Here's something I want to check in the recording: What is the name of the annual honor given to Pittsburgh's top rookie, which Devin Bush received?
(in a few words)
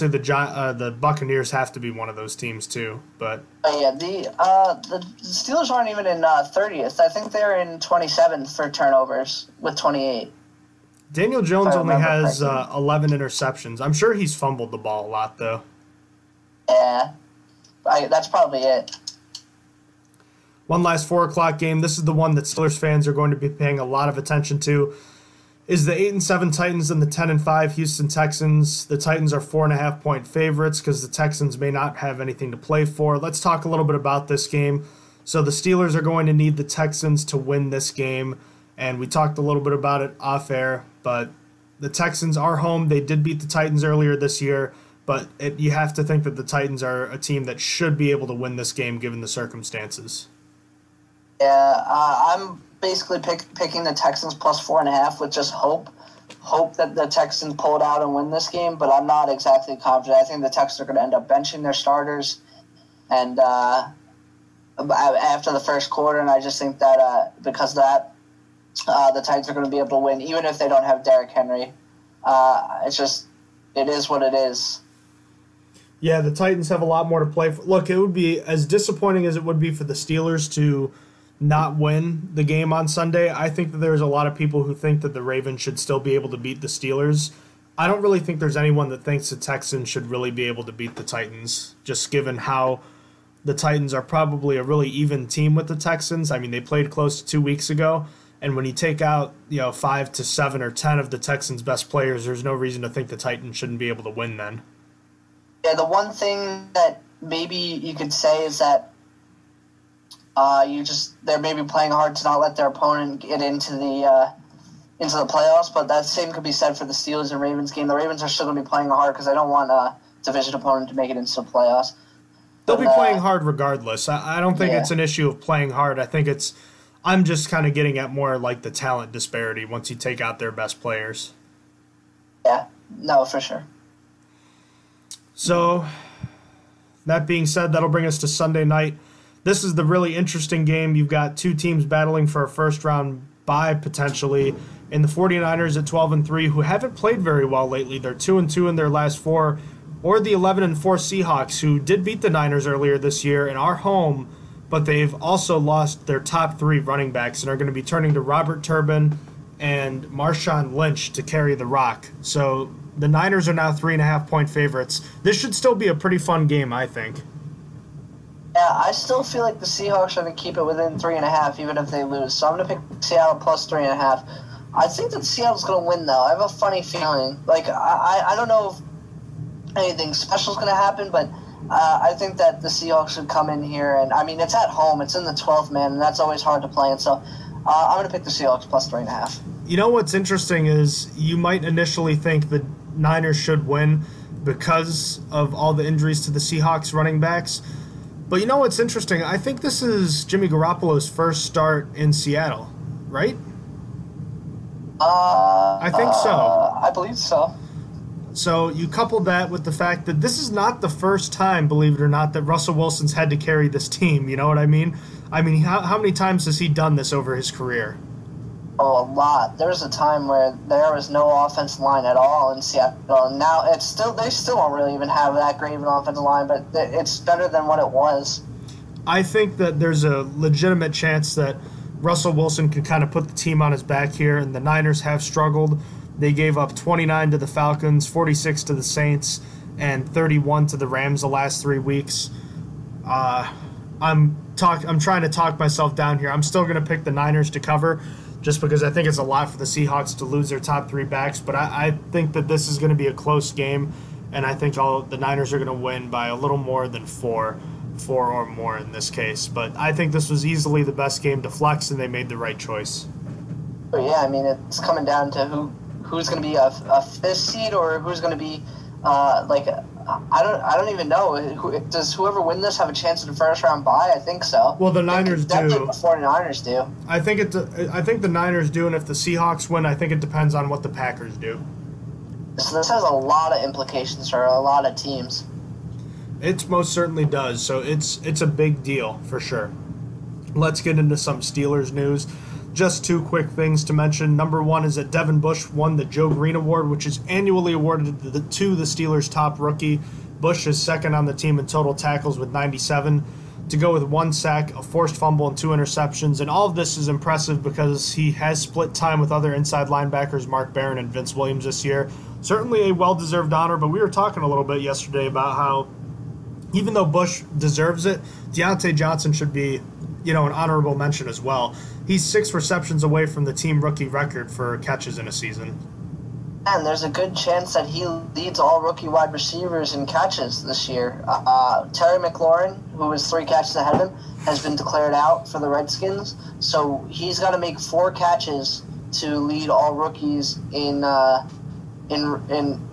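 Joe Greene Award.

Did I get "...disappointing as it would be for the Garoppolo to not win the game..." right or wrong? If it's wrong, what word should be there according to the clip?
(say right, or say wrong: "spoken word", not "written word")
wrong: "Steelers", not "Garoppolo".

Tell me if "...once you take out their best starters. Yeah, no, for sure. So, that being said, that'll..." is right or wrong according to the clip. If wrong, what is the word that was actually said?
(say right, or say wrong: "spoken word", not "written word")
wrong: "players", not "starters".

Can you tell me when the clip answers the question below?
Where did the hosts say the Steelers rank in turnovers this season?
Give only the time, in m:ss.
0:07.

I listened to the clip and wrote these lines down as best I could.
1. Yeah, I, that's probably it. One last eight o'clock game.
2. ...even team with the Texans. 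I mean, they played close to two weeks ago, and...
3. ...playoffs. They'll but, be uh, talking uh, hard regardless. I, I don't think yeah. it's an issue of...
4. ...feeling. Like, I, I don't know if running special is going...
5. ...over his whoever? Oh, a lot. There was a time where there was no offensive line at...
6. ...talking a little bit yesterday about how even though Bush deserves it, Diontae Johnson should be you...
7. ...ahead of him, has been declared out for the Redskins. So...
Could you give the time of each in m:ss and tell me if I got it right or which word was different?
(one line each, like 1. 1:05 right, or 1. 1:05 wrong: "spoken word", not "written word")
1. 0:16 wrong: "four", not "eight"
2. 1:34 right
3. 2:01 wrong: "playing", not "talking"
4. 2:56 wrong: "anything", not "running"
5. 3:37 wrong: "career", not "whoever"
6. 5:14 right
7. 5:33 right.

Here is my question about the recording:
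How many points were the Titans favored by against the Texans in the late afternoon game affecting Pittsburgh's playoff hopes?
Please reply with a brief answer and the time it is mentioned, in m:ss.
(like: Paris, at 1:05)
4.5, at 0:29.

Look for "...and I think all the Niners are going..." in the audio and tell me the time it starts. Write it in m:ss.
4:14.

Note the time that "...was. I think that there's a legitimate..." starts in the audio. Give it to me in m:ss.
3:47.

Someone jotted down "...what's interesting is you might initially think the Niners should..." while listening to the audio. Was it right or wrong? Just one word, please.
right.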